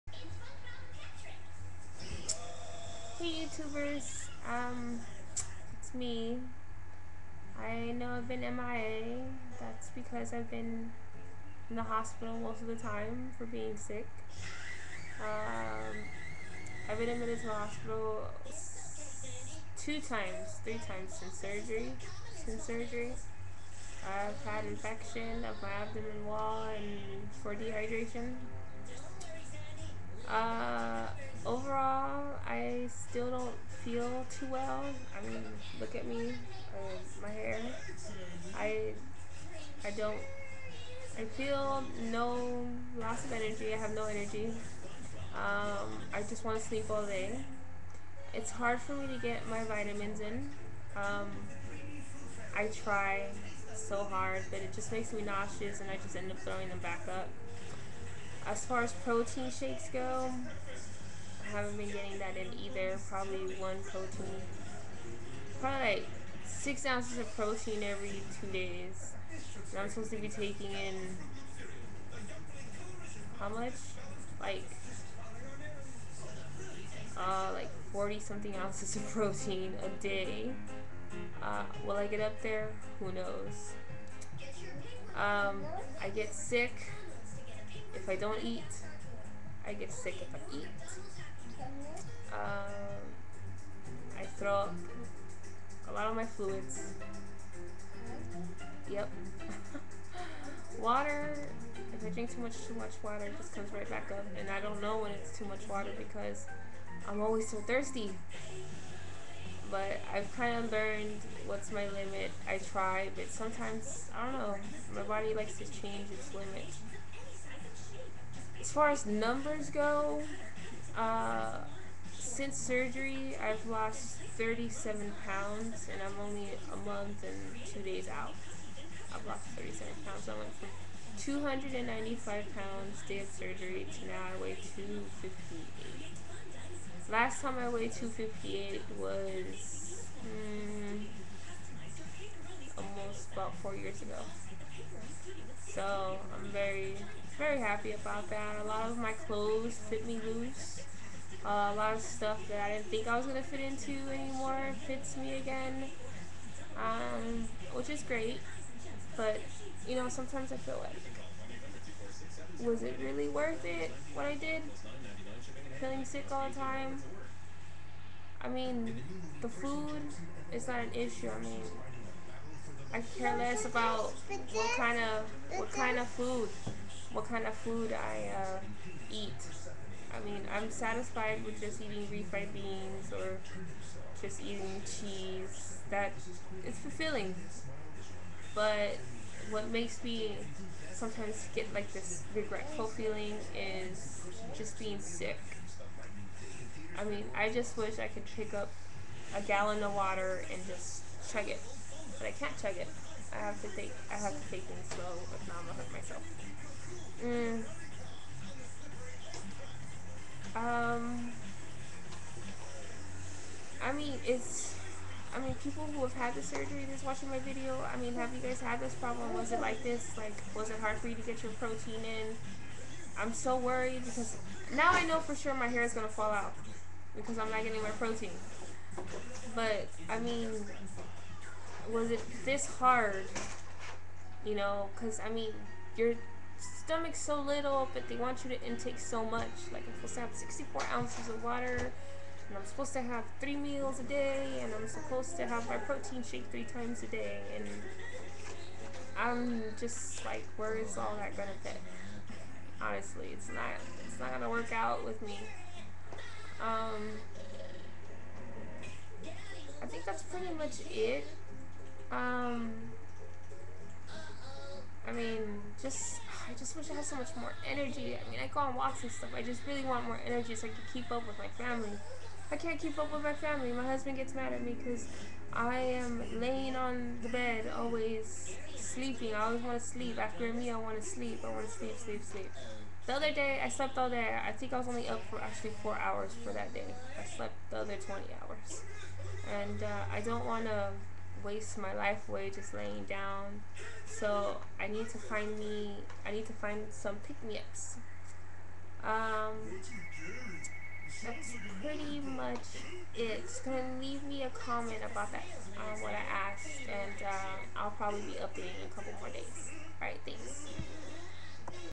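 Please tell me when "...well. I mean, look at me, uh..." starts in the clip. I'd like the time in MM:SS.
00:34.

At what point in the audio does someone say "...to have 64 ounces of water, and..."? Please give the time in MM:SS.
04:00.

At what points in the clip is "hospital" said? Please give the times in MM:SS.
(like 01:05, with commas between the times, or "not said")
00:11, 00:17.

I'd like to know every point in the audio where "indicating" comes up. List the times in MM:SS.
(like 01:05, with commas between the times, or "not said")
not said.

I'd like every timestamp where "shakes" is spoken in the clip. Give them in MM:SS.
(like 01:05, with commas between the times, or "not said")
00:59, 04:06.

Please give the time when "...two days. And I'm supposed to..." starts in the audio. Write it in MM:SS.
01:08.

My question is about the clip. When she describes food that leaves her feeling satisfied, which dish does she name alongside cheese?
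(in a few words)
refried beans.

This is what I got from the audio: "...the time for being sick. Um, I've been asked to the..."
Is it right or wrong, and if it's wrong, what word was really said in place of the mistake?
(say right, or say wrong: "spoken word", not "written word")
wrong: "admitted", not "asked".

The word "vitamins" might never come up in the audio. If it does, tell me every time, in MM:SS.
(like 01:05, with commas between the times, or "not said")
00:49.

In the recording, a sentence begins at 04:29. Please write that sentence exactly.
I just really want more energy so I can keep up with my family.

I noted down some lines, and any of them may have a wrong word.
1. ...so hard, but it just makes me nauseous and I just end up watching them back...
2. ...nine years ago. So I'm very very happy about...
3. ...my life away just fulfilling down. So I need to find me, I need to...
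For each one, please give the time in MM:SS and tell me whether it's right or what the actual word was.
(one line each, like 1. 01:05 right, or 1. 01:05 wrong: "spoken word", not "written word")
1. 00:53 wrong: "throwing", not "watching"
2. 02:23 wrong: "four", not "nine"
3. 04:51 wrong: "laying", not "fulfilling".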